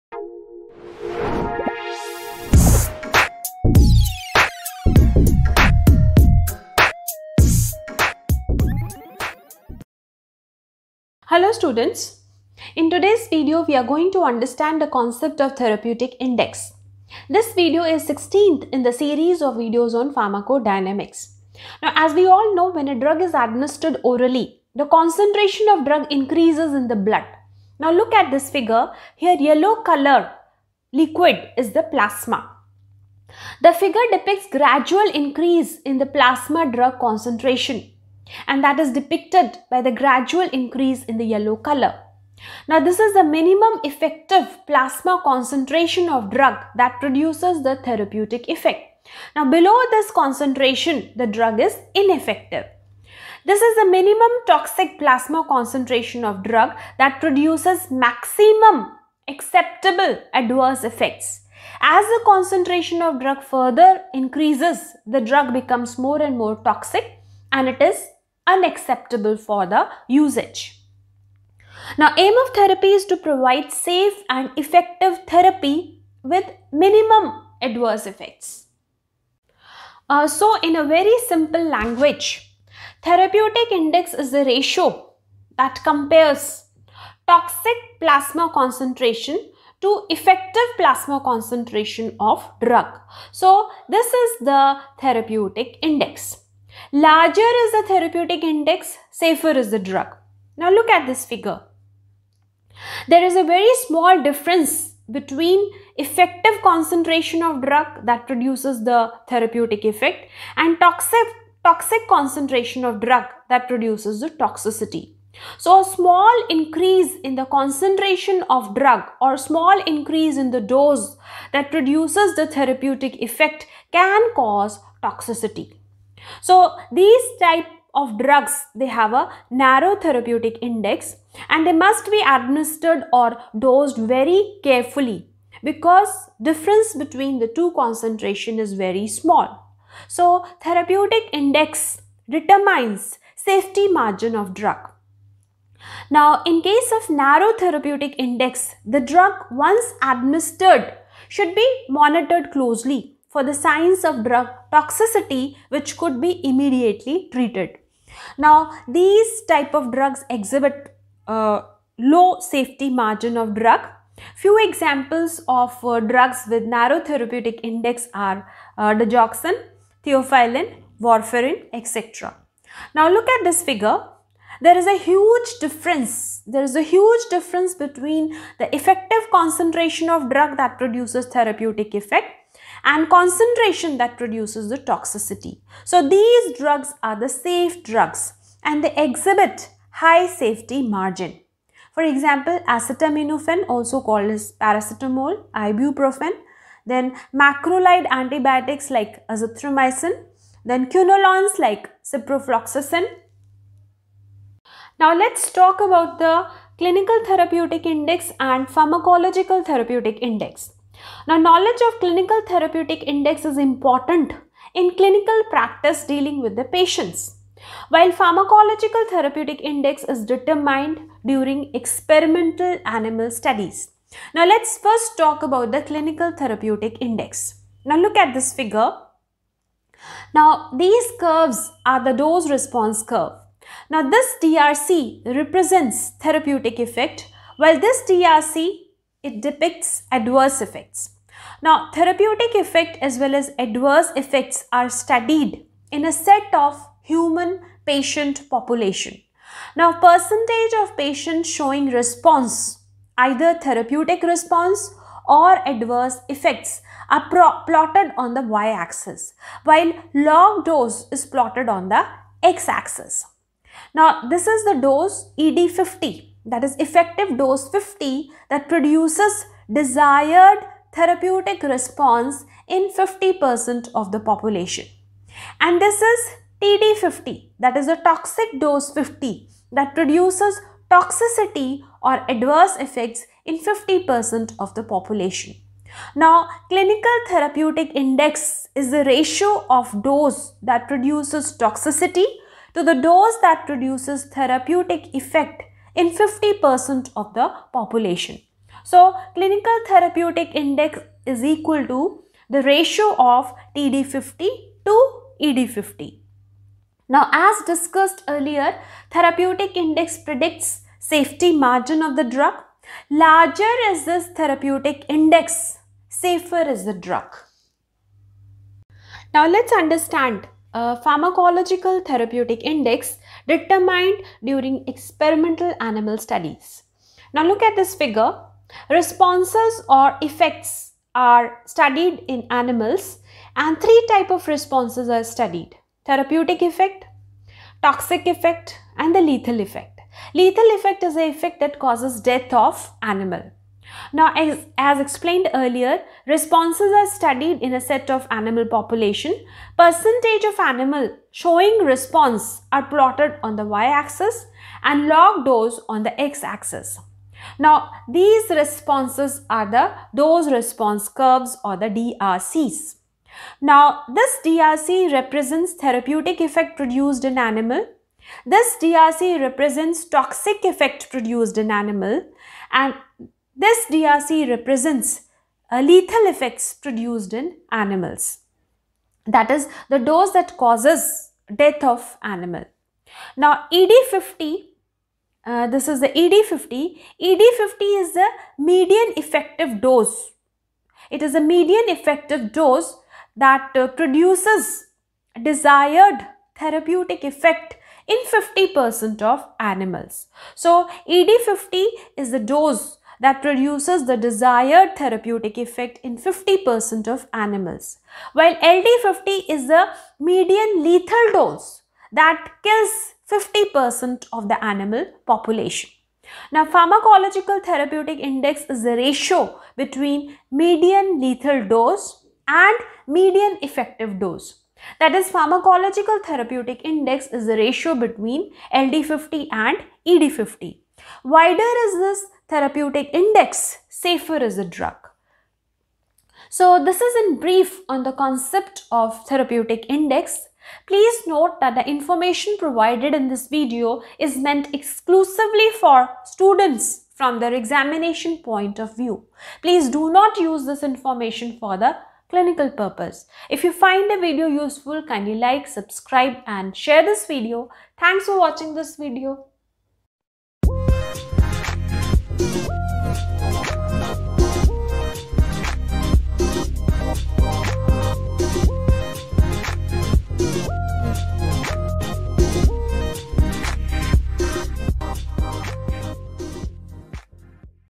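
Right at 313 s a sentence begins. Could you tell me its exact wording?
Larger is this therapeutic index, safer is the drug.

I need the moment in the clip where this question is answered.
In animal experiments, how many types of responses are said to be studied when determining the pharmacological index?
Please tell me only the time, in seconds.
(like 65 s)
333 s.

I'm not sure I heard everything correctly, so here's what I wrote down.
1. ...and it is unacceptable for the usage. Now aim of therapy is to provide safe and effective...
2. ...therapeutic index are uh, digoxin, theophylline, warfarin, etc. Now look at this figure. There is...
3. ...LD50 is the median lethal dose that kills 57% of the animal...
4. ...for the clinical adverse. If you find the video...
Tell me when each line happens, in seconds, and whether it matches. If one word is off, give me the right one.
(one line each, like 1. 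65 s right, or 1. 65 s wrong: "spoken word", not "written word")
1. 67 s right
2. 166 s right
3. 408 s wrong: "50", not "57"
4. 451 s wrong: "purpose", not "adverse".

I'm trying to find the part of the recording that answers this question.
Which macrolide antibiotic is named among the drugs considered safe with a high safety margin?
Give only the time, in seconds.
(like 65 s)
199 s.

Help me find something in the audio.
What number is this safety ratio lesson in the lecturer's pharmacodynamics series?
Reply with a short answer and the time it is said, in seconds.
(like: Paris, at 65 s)
16th, at 18 s.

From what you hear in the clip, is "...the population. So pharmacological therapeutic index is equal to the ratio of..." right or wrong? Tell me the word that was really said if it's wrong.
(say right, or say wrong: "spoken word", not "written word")
wrong: "clinical", not "pharmacological".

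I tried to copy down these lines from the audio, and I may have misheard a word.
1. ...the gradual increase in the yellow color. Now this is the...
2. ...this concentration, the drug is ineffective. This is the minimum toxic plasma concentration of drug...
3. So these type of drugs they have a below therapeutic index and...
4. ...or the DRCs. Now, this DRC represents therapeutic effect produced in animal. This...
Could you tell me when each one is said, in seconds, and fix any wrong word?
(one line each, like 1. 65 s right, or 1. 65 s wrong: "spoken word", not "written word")
1. 39 s right
2. 49 s right
3. 126 s wrong: "narrow", not "below"
4. 361 s right.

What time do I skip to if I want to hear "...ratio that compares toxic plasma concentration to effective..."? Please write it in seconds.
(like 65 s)
84 s.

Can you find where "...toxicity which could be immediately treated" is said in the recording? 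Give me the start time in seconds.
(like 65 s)
154 s.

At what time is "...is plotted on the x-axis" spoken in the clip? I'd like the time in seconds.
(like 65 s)
261 s.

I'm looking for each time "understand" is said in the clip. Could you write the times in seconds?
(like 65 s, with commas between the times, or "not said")
14 s, 319 s.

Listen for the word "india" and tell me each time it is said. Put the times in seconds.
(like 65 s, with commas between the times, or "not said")
not said.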